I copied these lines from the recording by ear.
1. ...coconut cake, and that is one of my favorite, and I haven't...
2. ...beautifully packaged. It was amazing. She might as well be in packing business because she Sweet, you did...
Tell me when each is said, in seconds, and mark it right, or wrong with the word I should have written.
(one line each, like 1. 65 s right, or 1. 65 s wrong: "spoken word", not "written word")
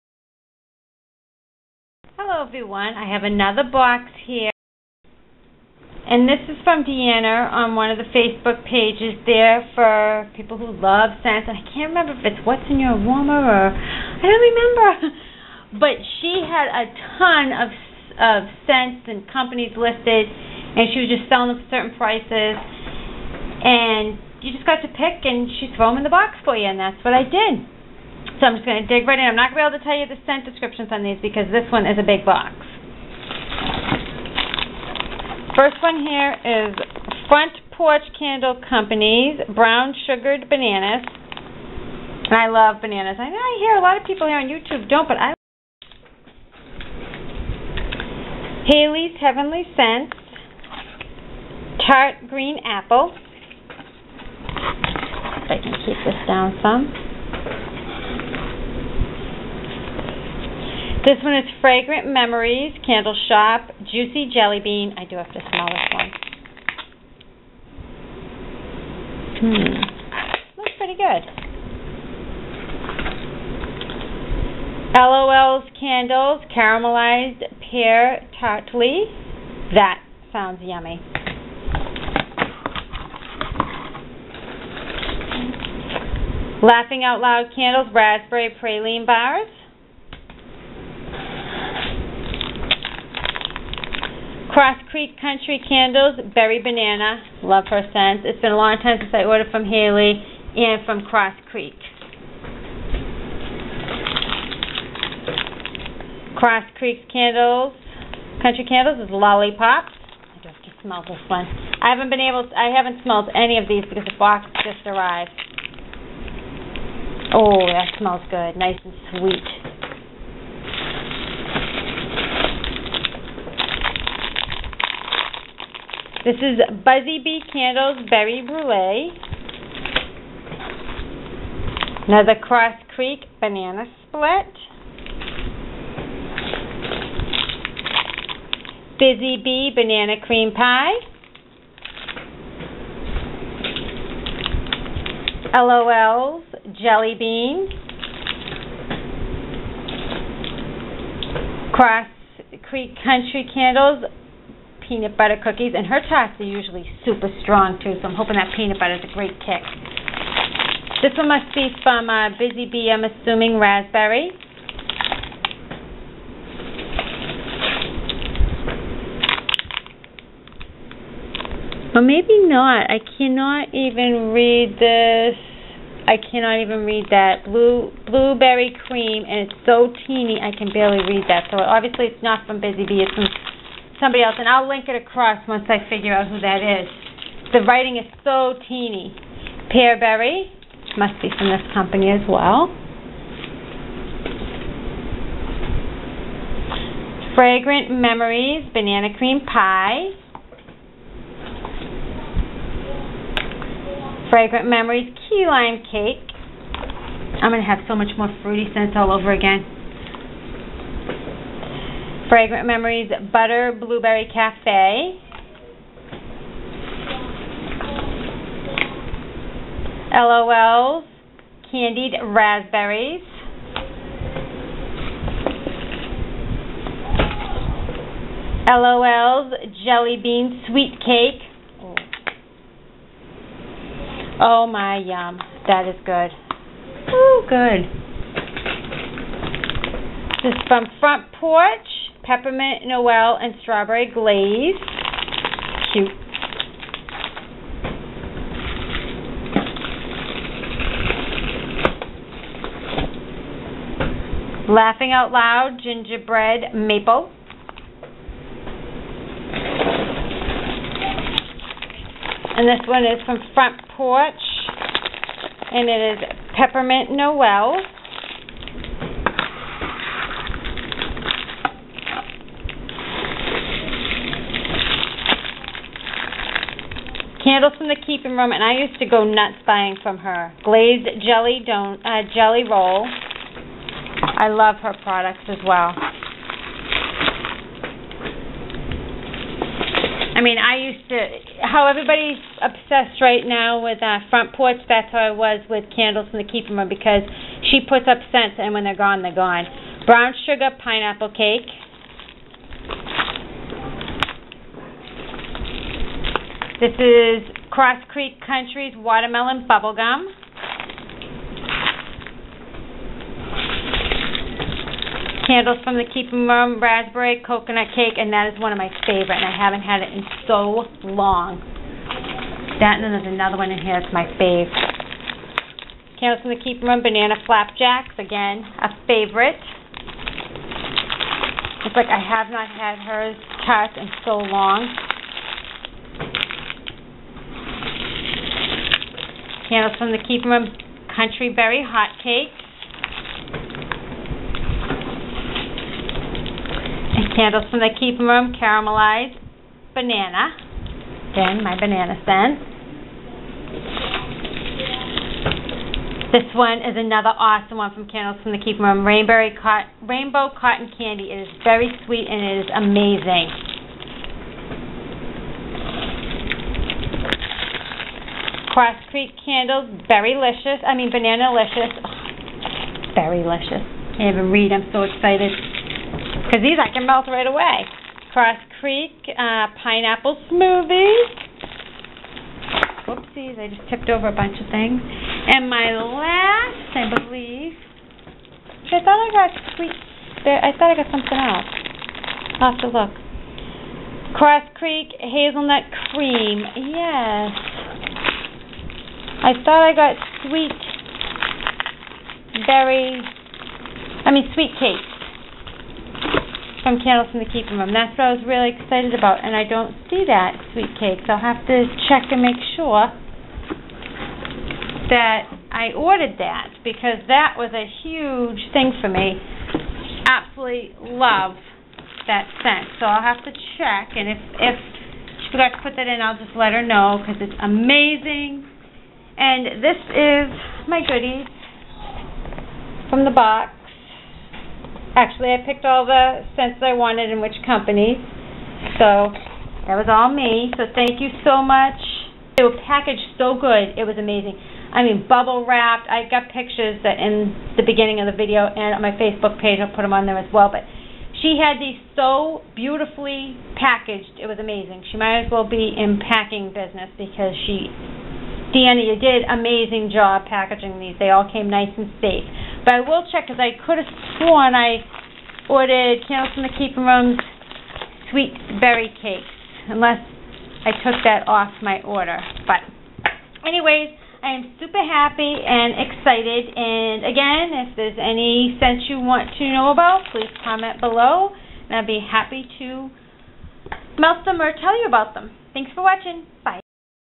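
1. 317 s right
2. 452 s wrong: "Danny", not "Sweet".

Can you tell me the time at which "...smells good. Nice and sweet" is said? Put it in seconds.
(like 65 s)
117 s.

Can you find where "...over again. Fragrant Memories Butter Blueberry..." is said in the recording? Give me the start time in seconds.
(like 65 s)
209 s.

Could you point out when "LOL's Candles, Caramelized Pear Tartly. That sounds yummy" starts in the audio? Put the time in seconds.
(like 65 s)
74 s.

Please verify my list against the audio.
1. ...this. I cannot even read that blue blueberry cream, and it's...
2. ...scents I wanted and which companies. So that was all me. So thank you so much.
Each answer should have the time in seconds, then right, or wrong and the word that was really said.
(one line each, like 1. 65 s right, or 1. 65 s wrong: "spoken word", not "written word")
1. 174 s right
2. 436 s right.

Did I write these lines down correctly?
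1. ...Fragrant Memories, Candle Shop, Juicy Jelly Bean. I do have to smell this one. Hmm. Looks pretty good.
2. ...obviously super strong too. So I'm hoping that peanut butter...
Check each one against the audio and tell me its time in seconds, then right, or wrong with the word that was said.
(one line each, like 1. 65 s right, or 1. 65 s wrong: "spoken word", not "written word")
1. 61 s right
2. 156 s wrong: "usually", not "obviously".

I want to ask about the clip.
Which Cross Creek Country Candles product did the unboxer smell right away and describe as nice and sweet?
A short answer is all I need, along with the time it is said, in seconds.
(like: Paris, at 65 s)
Lollipop, at 109 s.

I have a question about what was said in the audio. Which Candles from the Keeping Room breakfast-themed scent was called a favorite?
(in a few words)
Banana Flapjacks.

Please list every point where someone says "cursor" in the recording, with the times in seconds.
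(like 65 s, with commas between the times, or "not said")
not said.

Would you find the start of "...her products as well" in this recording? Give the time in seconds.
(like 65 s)
284 s.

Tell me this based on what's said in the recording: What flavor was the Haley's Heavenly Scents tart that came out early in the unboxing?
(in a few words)
Tart Green Apple.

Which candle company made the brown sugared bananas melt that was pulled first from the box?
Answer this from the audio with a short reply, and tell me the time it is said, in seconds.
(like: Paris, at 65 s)
Front Porch Candle Company, at 37 s.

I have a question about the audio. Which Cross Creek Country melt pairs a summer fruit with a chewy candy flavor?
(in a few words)
Watermelon Bubblegum.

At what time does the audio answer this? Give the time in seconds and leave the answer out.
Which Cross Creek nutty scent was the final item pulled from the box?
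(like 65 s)
395 s.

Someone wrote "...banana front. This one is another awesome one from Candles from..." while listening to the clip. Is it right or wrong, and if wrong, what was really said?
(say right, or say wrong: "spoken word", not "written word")
wrong: "scent", not "front".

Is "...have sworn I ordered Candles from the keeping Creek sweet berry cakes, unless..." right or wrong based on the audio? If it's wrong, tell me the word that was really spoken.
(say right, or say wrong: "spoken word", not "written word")
wrong: "Rooms", not "Creek".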